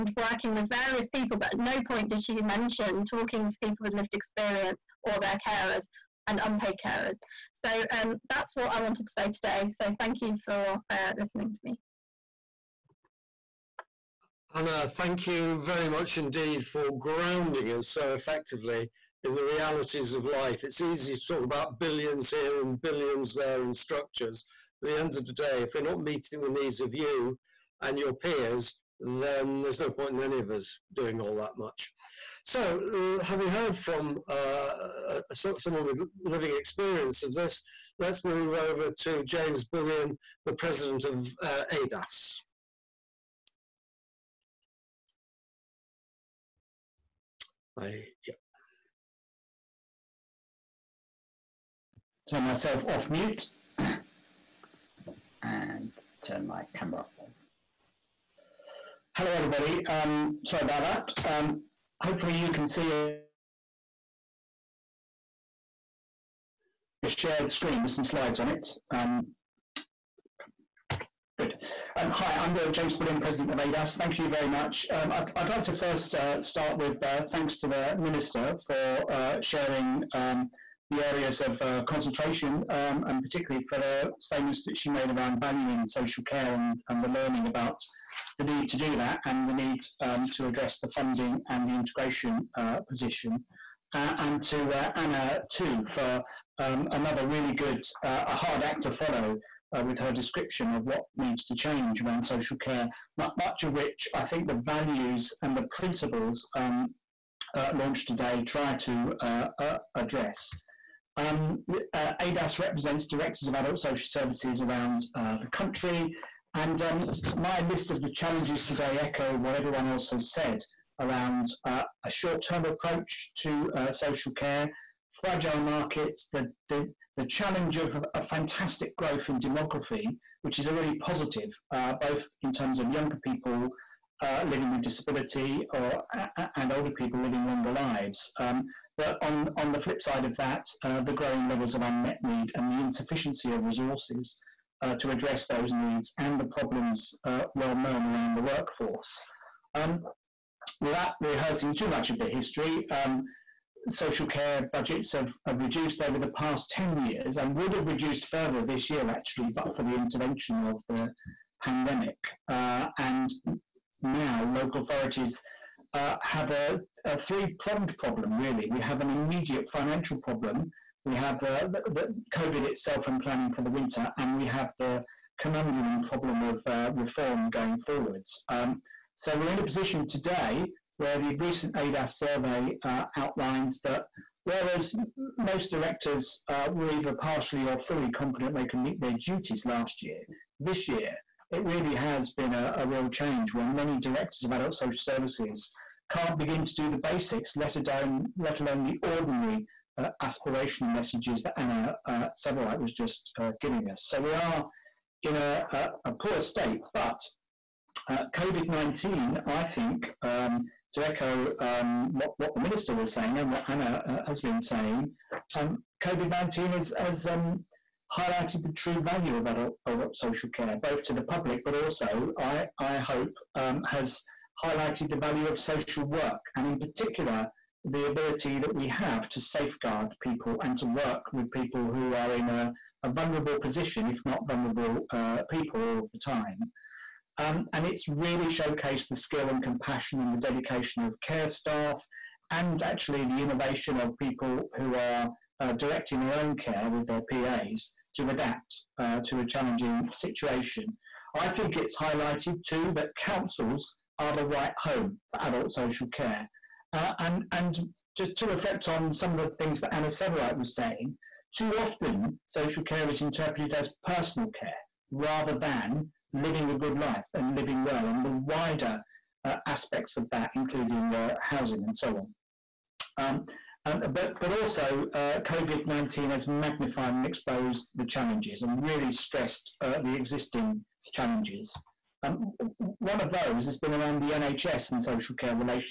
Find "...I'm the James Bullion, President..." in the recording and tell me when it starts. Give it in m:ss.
1:12.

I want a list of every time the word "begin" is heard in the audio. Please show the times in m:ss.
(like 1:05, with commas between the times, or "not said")
3:16.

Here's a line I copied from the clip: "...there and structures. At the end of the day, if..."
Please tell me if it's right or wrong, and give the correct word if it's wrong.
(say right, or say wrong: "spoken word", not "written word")
right.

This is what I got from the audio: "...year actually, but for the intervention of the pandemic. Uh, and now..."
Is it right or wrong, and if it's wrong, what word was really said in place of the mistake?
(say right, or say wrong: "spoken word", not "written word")
right.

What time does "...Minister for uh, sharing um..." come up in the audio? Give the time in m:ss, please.
1:17.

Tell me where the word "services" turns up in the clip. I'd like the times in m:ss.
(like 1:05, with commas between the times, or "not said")
1:54, 3:14.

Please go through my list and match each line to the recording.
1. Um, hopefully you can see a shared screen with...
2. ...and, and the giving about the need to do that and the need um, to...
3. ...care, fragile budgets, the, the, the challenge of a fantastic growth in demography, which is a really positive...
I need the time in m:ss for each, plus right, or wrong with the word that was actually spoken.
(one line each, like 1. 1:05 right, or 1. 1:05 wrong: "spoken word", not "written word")
1. 1:01 right
2. 1:26 wrong: "learning", not "giving"
3. 2:04 wrong: "markets", not "budgets".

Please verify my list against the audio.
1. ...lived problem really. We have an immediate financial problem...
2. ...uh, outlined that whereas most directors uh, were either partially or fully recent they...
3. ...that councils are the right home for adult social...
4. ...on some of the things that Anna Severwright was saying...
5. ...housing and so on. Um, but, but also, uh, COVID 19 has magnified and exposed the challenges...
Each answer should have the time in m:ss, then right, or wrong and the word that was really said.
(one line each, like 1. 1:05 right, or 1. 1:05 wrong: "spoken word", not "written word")
1. 2:47 wrong: "pronged", not "lived"
2. 3:02 wrong: "confident", not "recent"
3. 4:12 right
4. 4:18 right
5. 4:31 right.